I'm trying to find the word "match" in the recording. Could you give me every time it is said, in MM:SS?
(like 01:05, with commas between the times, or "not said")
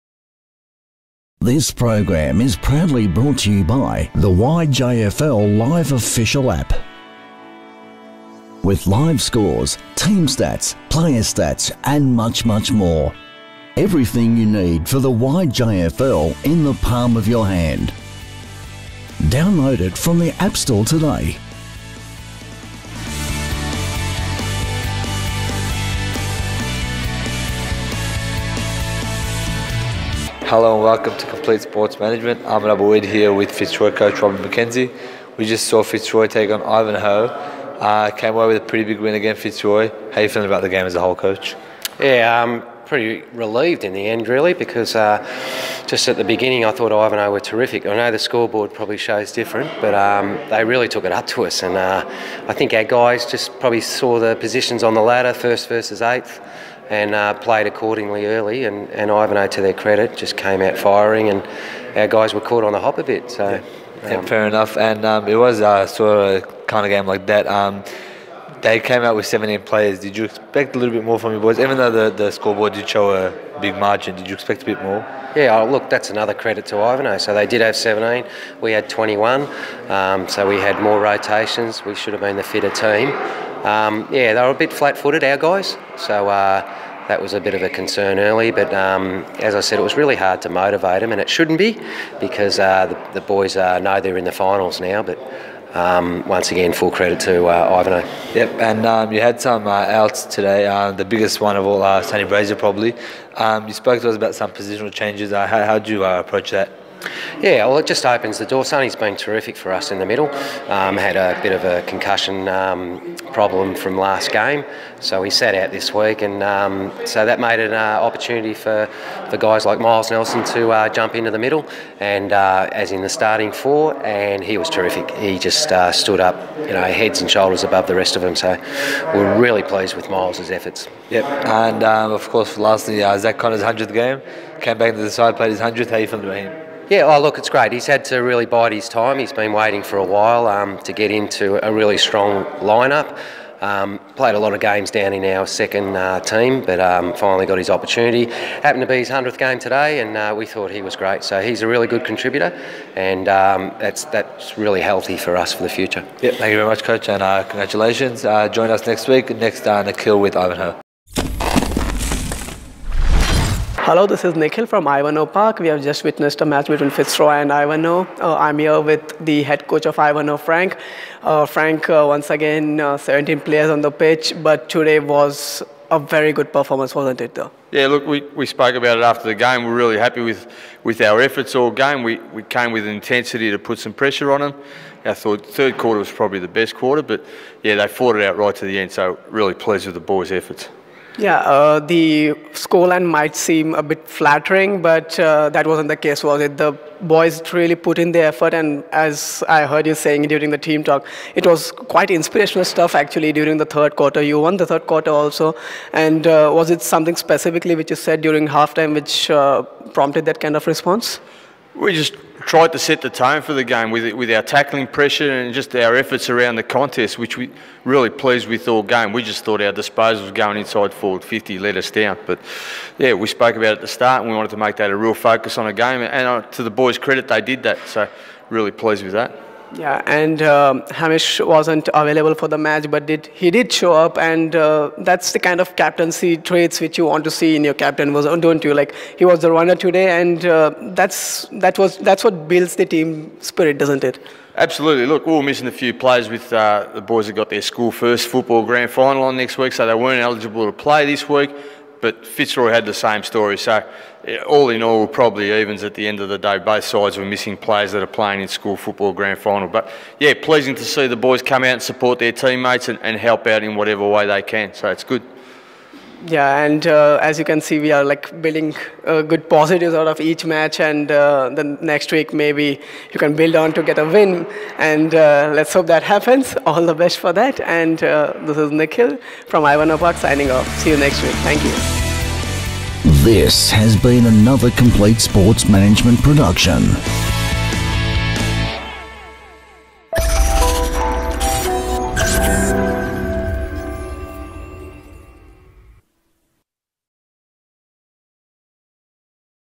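02:46, 03:52, 04:30.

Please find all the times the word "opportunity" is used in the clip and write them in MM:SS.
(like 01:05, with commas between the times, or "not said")
01:58, 02:27.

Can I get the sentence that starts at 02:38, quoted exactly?
Uh, join us next week, next uh, Nikhil with Ivanhoe.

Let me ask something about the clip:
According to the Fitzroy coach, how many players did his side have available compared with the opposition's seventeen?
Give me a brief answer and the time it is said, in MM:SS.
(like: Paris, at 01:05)
21, at 01:18.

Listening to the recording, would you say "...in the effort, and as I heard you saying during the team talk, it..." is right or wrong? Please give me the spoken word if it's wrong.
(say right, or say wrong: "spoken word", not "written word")
right.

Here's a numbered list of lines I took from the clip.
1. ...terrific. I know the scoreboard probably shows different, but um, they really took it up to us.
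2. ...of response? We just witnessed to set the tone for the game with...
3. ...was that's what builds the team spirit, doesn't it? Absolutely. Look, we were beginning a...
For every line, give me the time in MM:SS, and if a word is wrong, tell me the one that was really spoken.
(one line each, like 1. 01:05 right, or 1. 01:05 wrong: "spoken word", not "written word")
1. 00:47 right
2. 03:30 wrong: "tried", not "witnessed"
3. 04:01 wrong: "missing", not "beginning".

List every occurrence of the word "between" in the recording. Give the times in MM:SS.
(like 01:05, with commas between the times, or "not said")
02:46.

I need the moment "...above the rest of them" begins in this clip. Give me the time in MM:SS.
02:07.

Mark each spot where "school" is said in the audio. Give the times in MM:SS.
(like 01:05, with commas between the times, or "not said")
04:07, 04:18.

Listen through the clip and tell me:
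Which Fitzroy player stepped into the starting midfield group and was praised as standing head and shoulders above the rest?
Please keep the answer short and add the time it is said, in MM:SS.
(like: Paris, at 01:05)
Miles Nelson, at 01:59.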